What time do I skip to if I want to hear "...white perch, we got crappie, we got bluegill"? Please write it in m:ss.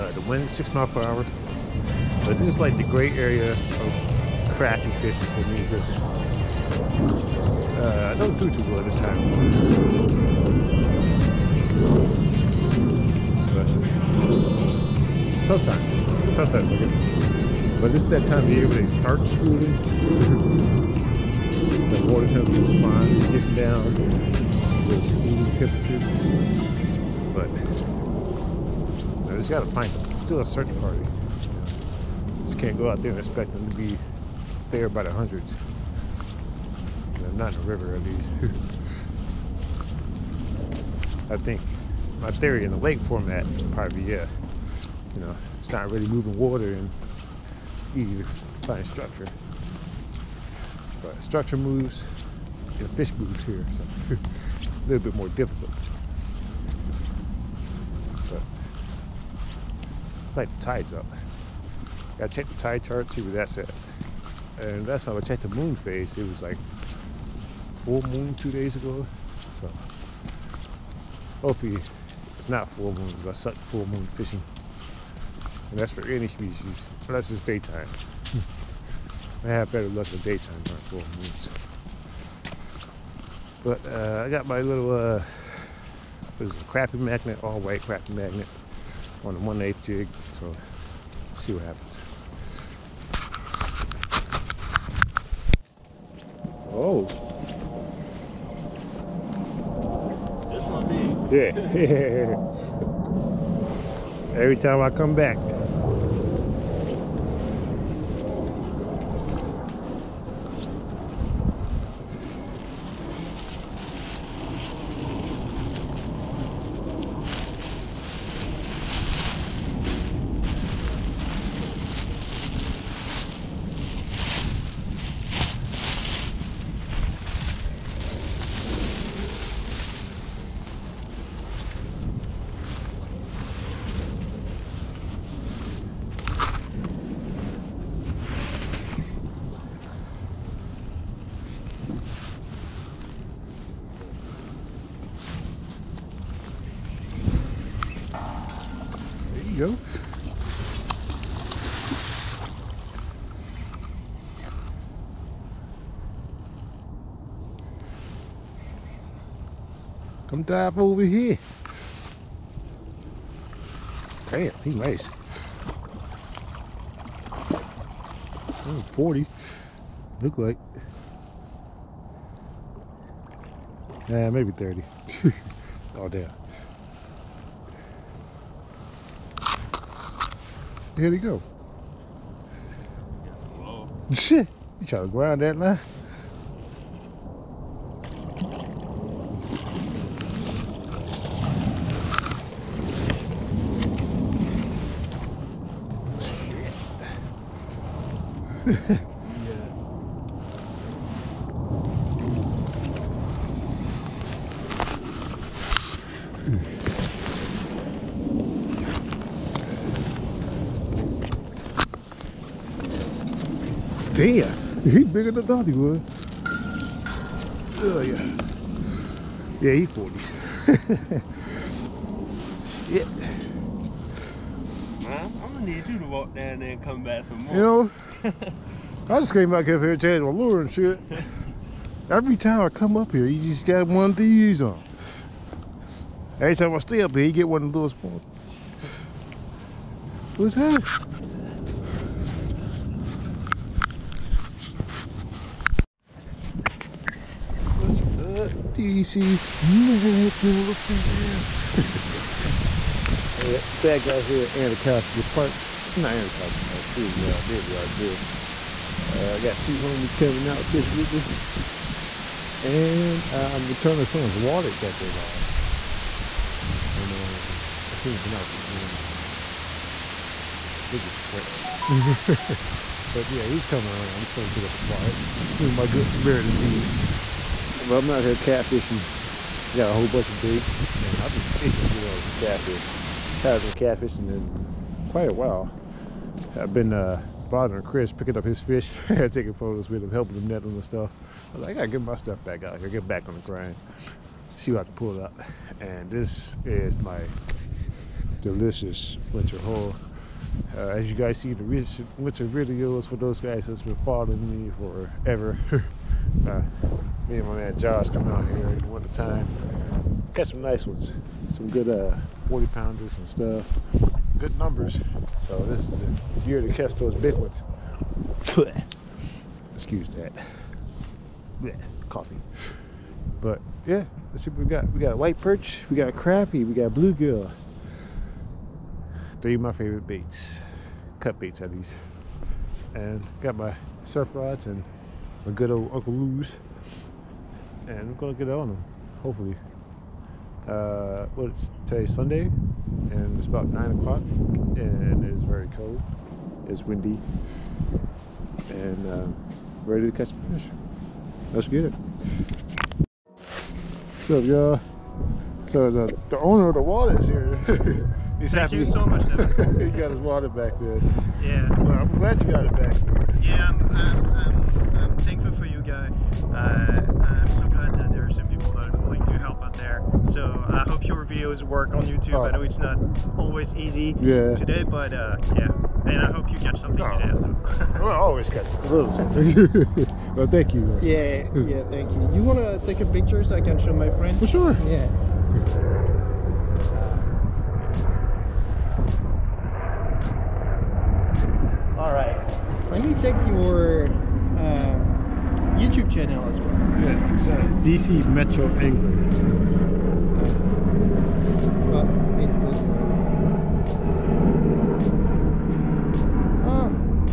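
5:25.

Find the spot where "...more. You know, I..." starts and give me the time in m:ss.
3:47.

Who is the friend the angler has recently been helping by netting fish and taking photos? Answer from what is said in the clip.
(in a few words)
Chris.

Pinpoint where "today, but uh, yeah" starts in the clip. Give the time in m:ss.
6:14.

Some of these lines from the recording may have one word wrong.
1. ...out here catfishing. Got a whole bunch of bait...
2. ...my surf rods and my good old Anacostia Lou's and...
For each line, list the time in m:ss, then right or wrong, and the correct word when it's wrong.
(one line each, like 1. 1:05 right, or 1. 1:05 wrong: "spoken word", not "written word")
1. 4:38 right
2. 5:33 wrong: "Uncle", not "Anacostia".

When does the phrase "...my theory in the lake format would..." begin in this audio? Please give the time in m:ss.
0:42.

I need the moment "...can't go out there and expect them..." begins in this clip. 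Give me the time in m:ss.
0:32.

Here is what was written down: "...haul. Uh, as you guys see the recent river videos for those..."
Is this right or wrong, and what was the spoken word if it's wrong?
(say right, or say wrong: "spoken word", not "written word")
wrong: "winter", not "river".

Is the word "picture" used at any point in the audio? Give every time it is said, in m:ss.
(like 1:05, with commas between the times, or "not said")
6:23.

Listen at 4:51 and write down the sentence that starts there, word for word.
I was like, I gotta get my stuff back out here, get back on the grind, see what I can pull out.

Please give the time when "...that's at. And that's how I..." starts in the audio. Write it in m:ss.
1:03.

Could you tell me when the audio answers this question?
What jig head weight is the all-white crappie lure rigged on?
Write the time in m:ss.
1:29.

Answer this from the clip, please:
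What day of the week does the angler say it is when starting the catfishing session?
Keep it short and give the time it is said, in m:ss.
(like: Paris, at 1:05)
Sunday, at 5:42.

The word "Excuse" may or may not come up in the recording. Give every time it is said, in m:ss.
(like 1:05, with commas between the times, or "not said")
5:19.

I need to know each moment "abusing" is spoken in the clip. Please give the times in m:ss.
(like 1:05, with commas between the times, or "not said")
not said.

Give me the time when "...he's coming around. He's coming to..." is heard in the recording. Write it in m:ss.
4:33.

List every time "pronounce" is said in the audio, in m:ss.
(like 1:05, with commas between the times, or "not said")
4:28.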